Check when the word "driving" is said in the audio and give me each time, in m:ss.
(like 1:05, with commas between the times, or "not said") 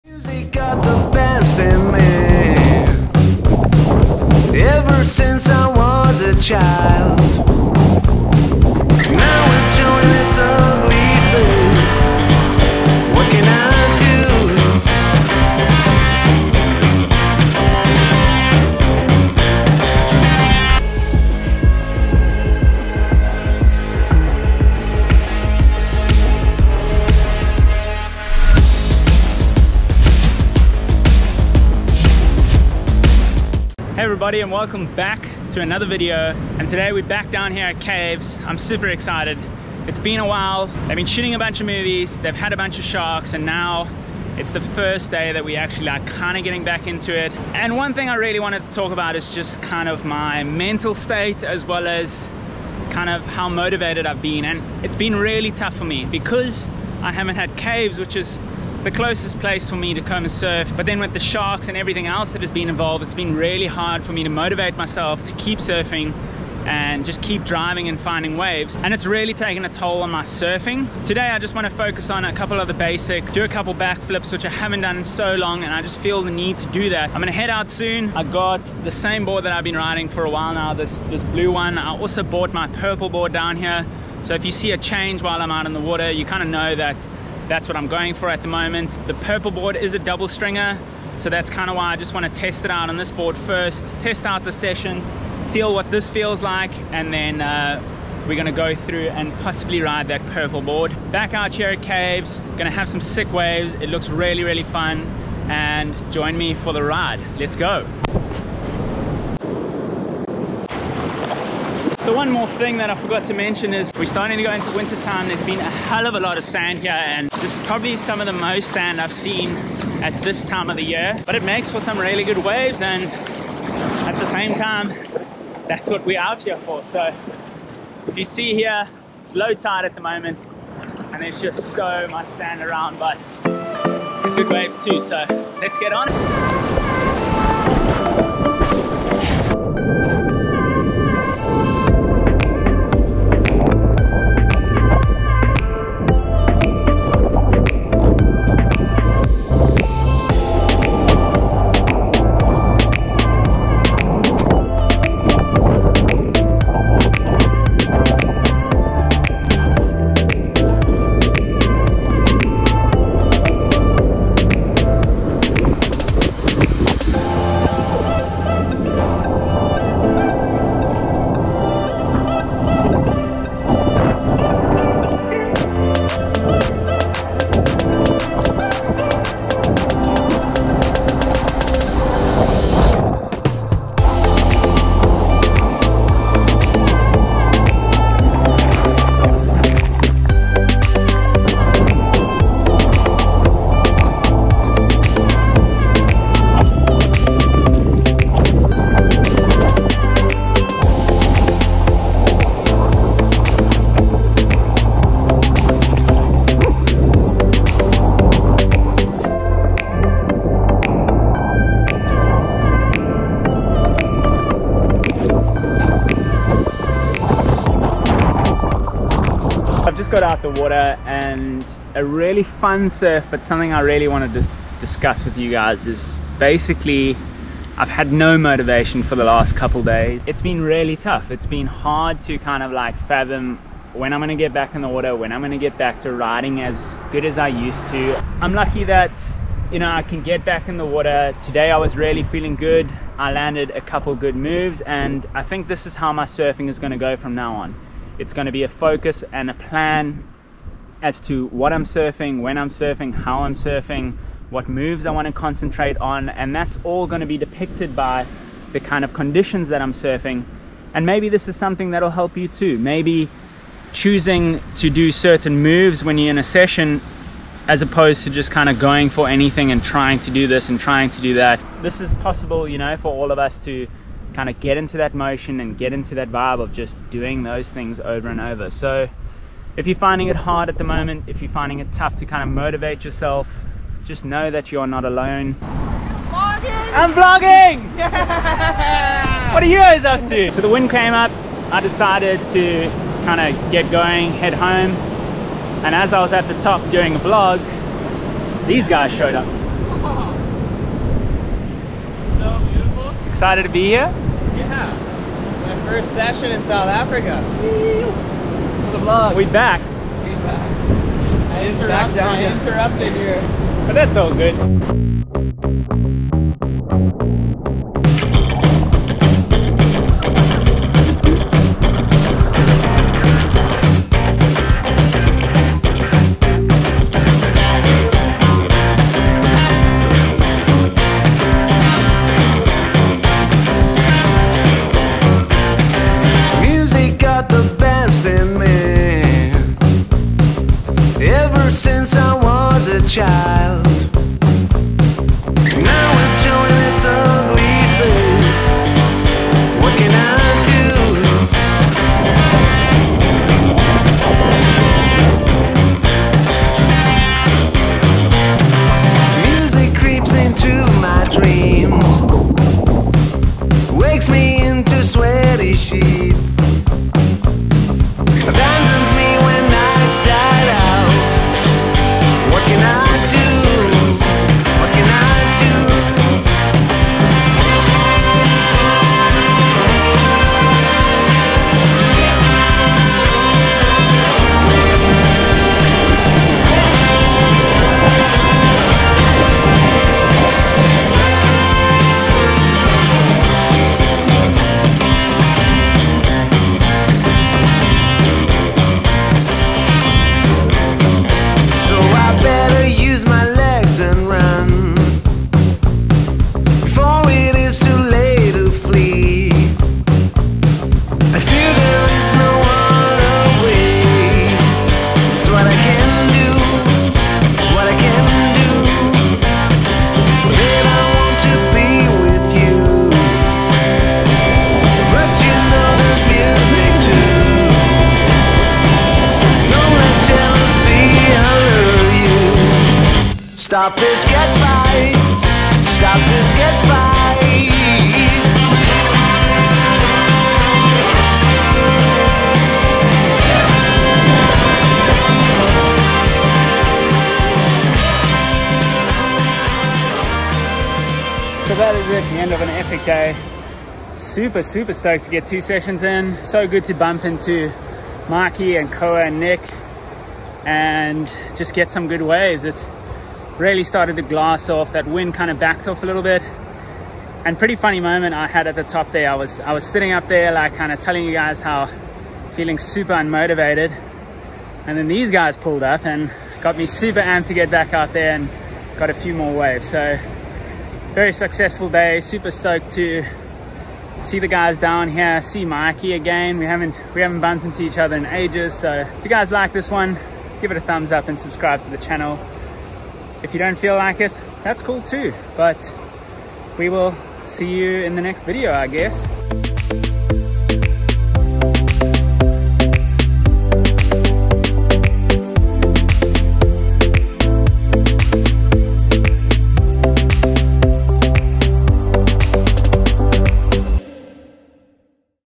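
1:07.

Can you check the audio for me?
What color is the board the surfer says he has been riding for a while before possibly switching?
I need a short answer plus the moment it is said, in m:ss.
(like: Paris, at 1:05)
Blue, at 1:21.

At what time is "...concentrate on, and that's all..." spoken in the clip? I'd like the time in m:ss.
4:15.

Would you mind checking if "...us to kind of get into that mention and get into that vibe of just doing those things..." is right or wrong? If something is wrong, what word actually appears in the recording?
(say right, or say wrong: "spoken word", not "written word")
wrong: "motion", not "mention".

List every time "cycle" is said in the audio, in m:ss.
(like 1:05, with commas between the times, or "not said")
not said.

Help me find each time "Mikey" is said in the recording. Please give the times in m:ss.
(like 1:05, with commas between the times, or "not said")
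8:05.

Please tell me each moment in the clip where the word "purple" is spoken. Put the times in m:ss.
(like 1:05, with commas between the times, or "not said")
1:22, 1:29, 1:40.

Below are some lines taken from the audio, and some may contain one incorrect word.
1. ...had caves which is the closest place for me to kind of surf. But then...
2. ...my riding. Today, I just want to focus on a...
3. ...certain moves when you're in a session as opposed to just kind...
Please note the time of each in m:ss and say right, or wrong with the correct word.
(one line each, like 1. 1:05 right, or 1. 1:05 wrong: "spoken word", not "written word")
1. 0:57 right
2. 1:10 wrong: "surfing", not "riding"
3. 4:25 right.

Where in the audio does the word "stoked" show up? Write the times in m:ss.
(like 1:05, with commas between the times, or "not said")
7:34, 8:02.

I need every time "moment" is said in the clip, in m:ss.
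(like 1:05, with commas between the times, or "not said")
1:28, 2:10, 4:40, 7:47.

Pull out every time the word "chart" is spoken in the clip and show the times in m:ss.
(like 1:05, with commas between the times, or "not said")
not said.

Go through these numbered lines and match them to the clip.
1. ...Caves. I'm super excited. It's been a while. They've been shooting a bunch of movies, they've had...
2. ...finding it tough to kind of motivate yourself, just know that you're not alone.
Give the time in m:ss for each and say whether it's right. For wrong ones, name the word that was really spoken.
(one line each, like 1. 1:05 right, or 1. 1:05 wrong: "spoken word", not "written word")
1. 0:37 right
2. 4:41 right.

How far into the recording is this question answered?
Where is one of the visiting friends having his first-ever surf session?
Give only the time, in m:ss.
5:06.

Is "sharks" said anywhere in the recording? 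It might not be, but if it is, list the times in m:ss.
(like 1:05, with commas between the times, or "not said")
0:42, 1:01.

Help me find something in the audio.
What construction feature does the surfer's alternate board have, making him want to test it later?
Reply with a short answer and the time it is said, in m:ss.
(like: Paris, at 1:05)
Double stringer, at 1:29.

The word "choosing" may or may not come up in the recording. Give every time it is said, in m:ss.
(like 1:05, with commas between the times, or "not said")
4:23.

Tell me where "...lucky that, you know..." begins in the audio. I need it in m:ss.
3:58.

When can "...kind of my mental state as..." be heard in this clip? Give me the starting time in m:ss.
0:49.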